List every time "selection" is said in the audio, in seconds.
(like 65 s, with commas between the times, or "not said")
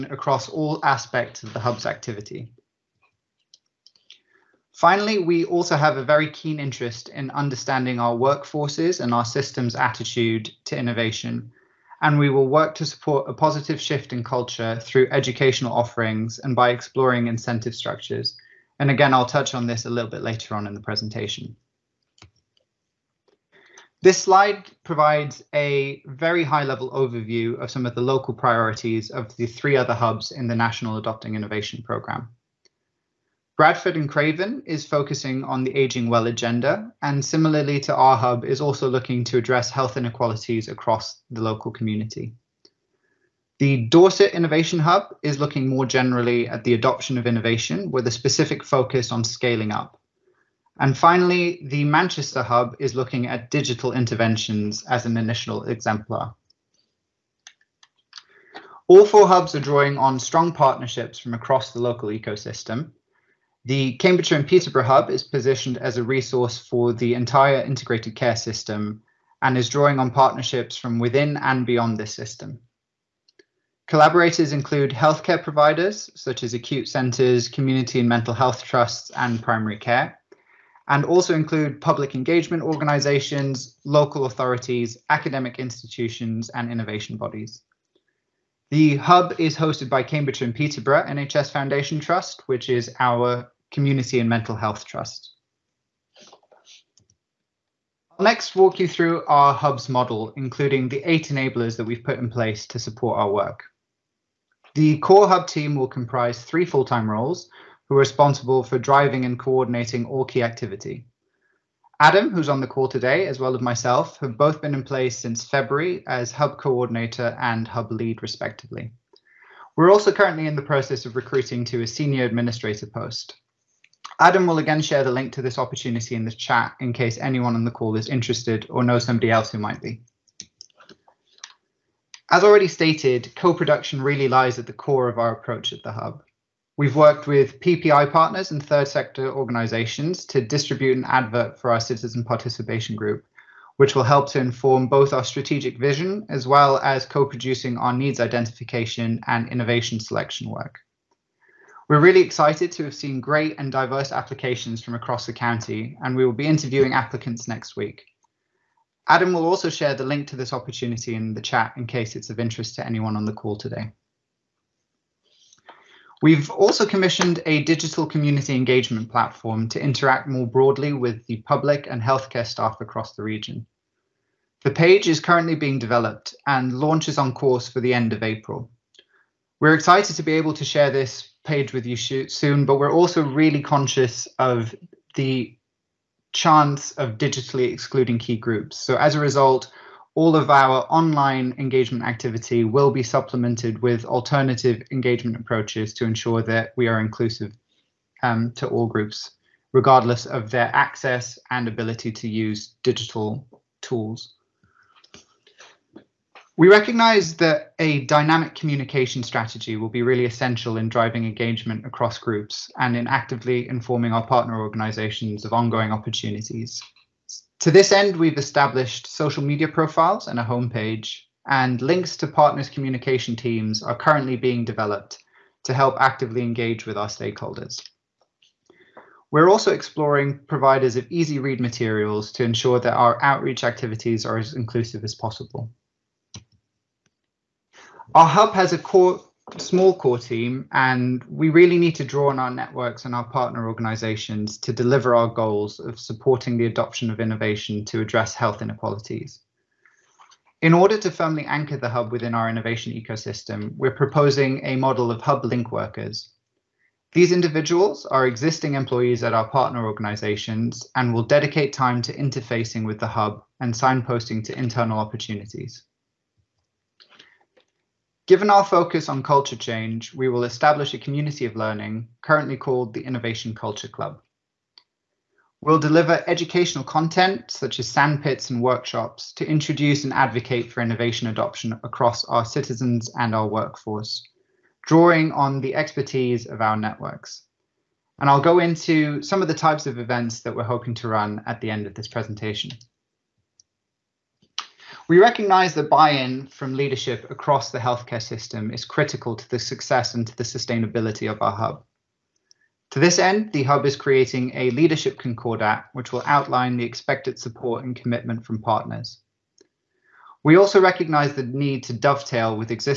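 150 s.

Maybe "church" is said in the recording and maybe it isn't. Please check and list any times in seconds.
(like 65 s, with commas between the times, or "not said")
not said.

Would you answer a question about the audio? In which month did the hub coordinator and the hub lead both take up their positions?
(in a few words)
February.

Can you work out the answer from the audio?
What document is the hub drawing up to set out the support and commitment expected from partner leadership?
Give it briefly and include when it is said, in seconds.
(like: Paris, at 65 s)
Leadership concordat, at 304 s.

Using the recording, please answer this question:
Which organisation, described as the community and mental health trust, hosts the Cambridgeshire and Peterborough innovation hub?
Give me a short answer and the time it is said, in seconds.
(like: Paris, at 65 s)
Cambridge and Peterborough NHS Foundation Trust, at 90 s.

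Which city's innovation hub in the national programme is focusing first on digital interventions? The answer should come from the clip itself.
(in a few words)
Manchester.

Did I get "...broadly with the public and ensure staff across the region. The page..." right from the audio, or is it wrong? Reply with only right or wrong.
wrong.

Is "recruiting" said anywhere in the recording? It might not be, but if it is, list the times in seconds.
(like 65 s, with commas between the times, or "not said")
121 s.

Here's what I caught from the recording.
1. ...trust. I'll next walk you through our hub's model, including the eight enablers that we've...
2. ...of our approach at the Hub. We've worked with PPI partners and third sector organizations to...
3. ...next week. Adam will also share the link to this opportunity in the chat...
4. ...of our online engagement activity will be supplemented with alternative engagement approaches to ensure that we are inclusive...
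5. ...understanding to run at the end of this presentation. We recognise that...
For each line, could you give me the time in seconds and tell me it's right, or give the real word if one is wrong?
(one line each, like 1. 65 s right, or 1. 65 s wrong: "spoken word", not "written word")
1. 94 s right
2. 135 s right
3. 157 s right
4. 190 s right
5. 290 s wrong: "hoping", not "understanding".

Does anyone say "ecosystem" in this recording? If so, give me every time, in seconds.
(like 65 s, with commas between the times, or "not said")
62 s, 252 s.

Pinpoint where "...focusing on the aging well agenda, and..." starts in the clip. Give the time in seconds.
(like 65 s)
34 s.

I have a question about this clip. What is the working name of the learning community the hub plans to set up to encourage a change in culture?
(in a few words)
Innovation Culture Club.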